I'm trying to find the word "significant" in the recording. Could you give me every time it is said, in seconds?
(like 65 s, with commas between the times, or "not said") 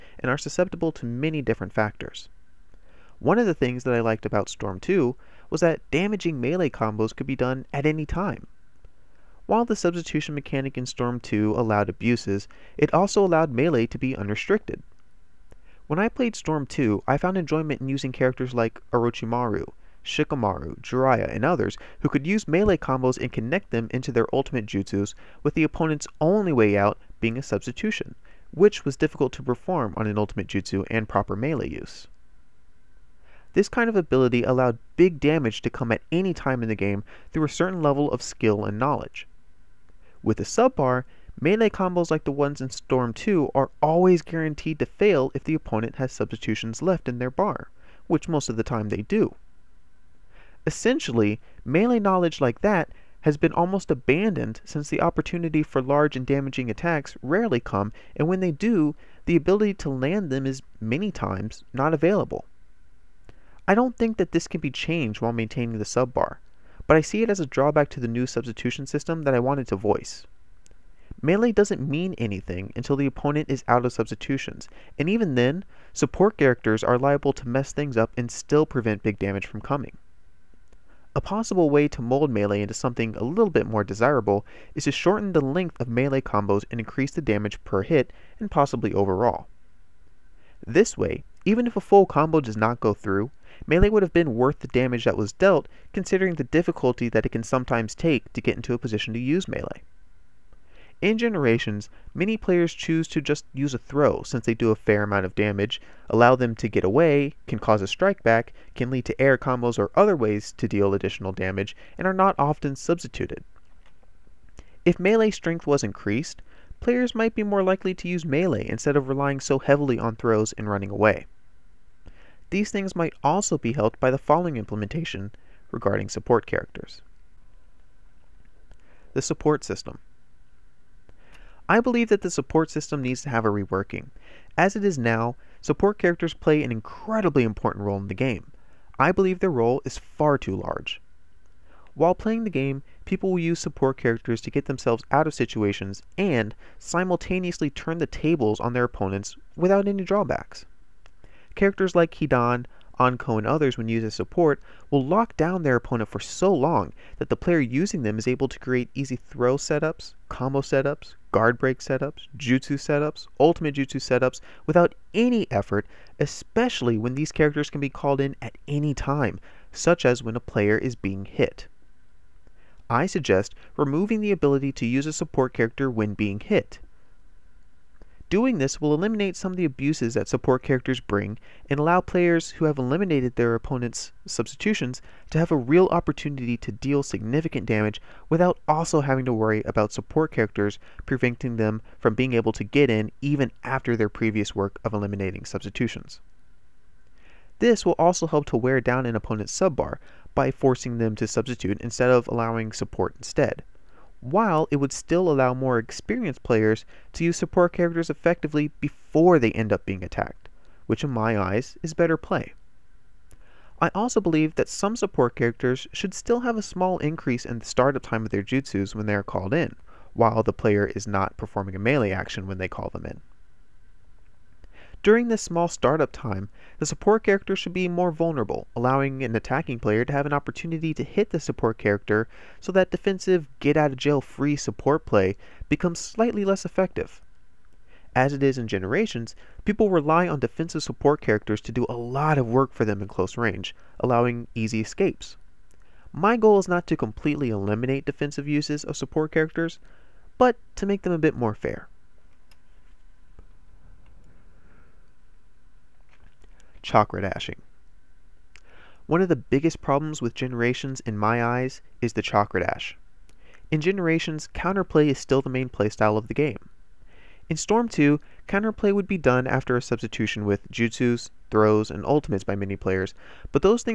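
187 s.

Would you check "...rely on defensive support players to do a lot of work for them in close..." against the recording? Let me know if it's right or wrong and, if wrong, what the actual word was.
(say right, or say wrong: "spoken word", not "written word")
wrong: "characters", not "players".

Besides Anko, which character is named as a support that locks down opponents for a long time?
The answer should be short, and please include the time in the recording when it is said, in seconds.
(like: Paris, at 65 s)
Hidan, at 152 s.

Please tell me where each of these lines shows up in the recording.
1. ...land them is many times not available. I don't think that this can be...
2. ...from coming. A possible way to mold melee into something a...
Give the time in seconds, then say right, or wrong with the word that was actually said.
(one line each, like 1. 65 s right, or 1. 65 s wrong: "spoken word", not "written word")
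1. 59 s right
2. 79 s right.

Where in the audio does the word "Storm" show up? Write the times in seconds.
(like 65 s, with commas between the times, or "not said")
4 s, 10 s, 16 s, 42 s, 267 s.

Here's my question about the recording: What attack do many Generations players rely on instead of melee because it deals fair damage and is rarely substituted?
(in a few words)
a throw.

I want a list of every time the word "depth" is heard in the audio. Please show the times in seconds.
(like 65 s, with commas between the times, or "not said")
not said.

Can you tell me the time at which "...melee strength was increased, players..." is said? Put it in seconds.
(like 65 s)
114 s.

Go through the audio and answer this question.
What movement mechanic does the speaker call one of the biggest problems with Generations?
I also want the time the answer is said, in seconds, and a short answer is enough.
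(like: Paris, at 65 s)
chakra dash, at 262 s.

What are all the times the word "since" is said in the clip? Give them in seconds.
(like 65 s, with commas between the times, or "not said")
54 s, 104 s.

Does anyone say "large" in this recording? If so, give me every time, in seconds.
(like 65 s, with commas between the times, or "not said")
55 s, 140 s.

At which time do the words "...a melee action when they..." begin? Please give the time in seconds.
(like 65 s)
221 s.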